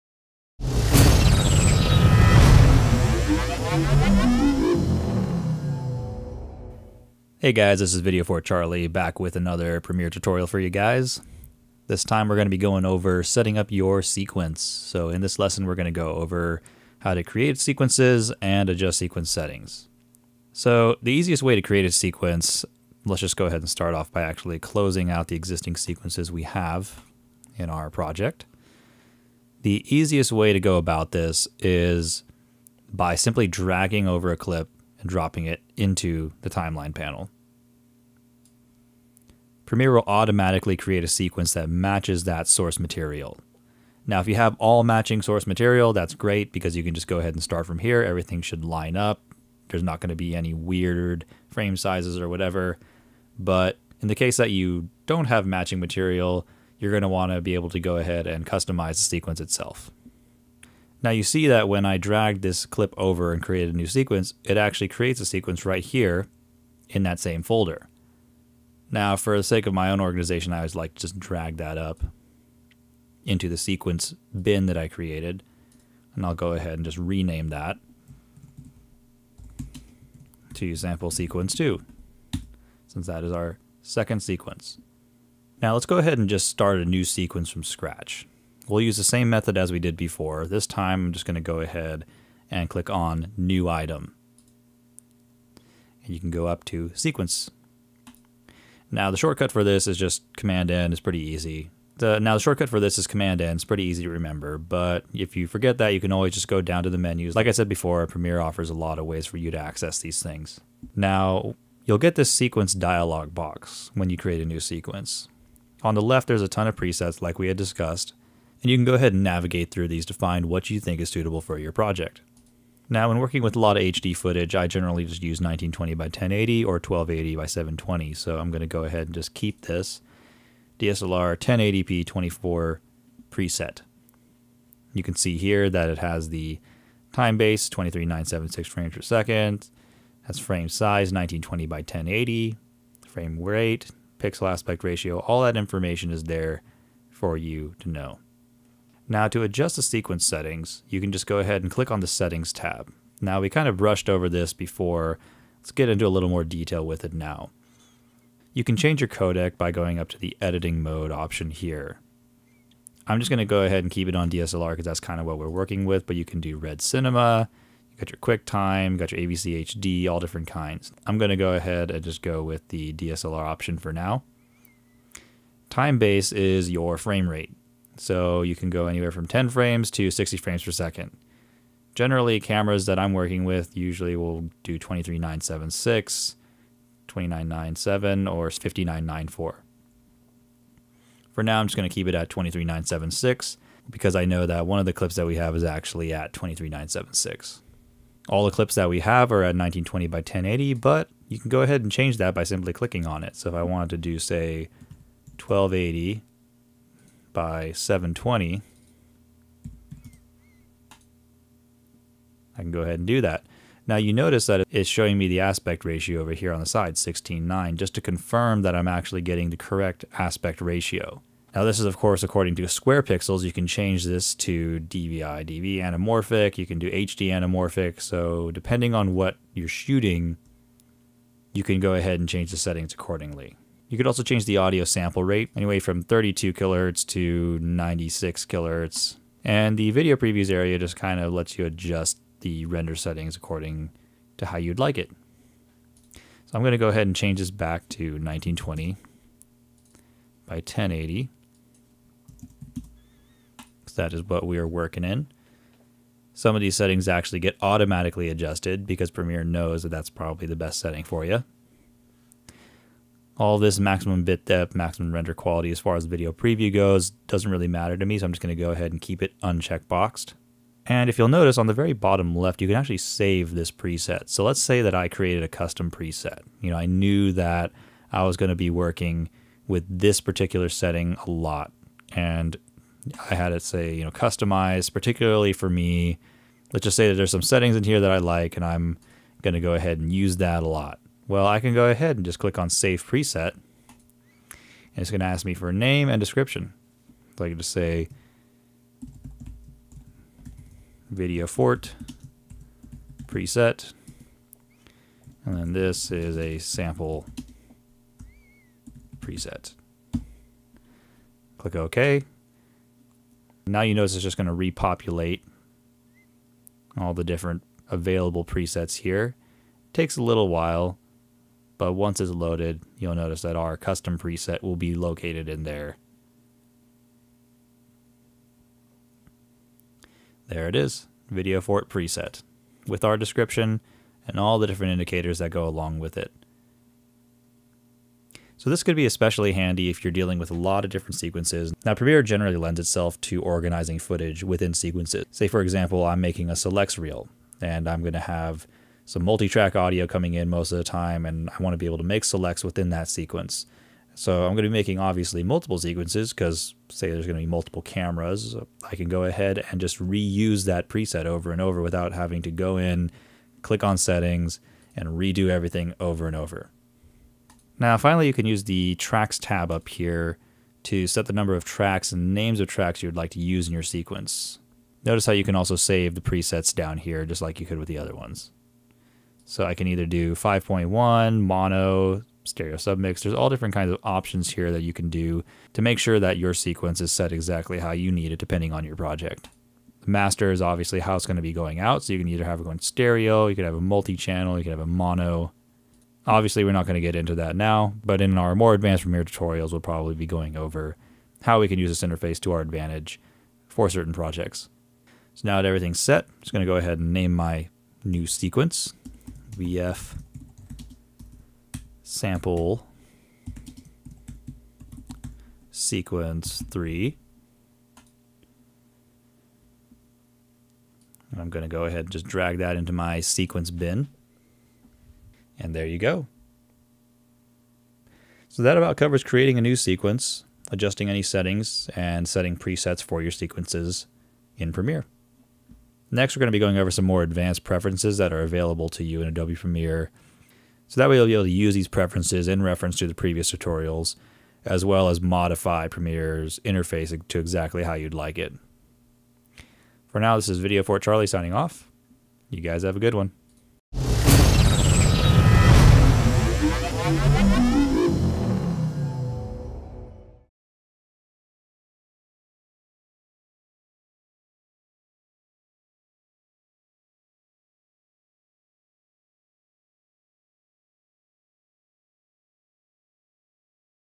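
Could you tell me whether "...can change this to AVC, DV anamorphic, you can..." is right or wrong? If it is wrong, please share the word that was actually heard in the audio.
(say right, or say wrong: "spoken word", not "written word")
wrong: "DVI", not "AVC".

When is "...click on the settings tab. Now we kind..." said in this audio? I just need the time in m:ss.
2:31.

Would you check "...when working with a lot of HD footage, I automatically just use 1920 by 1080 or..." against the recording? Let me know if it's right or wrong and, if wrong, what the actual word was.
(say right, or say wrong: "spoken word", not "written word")
wrong: "generally", not "automatically".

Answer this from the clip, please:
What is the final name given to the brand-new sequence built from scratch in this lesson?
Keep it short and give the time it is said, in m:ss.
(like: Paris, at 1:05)
vf sample sequence 3, at 6:49.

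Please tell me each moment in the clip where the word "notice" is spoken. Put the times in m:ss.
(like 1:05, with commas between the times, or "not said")
3:34, 4:31, 5:13, 5:23, 6:15.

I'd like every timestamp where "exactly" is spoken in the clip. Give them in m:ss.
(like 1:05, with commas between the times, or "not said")
6:27, 7:27.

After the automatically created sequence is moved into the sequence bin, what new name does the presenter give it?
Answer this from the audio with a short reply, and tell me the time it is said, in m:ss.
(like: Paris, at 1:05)
sample sequence 2, at 1:20.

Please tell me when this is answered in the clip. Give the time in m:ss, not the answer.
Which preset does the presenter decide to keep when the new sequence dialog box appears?
2:10.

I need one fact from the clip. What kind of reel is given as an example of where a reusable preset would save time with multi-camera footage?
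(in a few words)
selects reel.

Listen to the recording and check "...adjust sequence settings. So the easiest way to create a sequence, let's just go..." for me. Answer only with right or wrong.
right.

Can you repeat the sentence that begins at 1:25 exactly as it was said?
Now let's go ahead and just start a new sequence from scratch.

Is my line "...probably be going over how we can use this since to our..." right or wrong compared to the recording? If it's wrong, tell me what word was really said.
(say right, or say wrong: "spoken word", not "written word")
wrong: "interface", not "since".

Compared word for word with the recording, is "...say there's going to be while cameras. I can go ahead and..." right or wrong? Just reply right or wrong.
wrong.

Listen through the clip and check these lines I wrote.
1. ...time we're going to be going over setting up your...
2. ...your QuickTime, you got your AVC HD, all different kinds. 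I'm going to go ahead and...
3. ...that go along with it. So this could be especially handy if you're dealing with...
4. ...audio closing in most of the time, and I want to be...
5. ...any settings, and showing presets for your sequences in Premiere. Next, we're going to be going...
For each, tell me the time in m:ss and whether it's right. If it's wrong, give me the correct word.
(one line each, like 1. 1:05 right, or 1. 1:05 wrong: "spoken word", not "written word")
1. 0:12 right
2. 2:48 right
3. 5:35 right
4. 5:49 wrong: "coming", not "closing"
5. 7:11 wrong: "setting", not "showing".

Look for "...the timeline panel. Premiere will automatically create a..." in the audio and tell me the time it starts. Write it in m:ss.
0:36.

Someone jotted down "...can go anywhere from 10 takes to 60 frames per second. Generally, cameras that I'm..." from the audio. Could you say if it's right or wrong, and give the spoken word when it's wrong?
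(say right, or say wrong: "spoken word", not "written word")
wrong: "frames", not "takes".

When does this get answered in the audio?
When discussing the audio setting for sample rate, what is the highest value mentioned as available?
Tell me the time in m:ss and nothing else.
3:57.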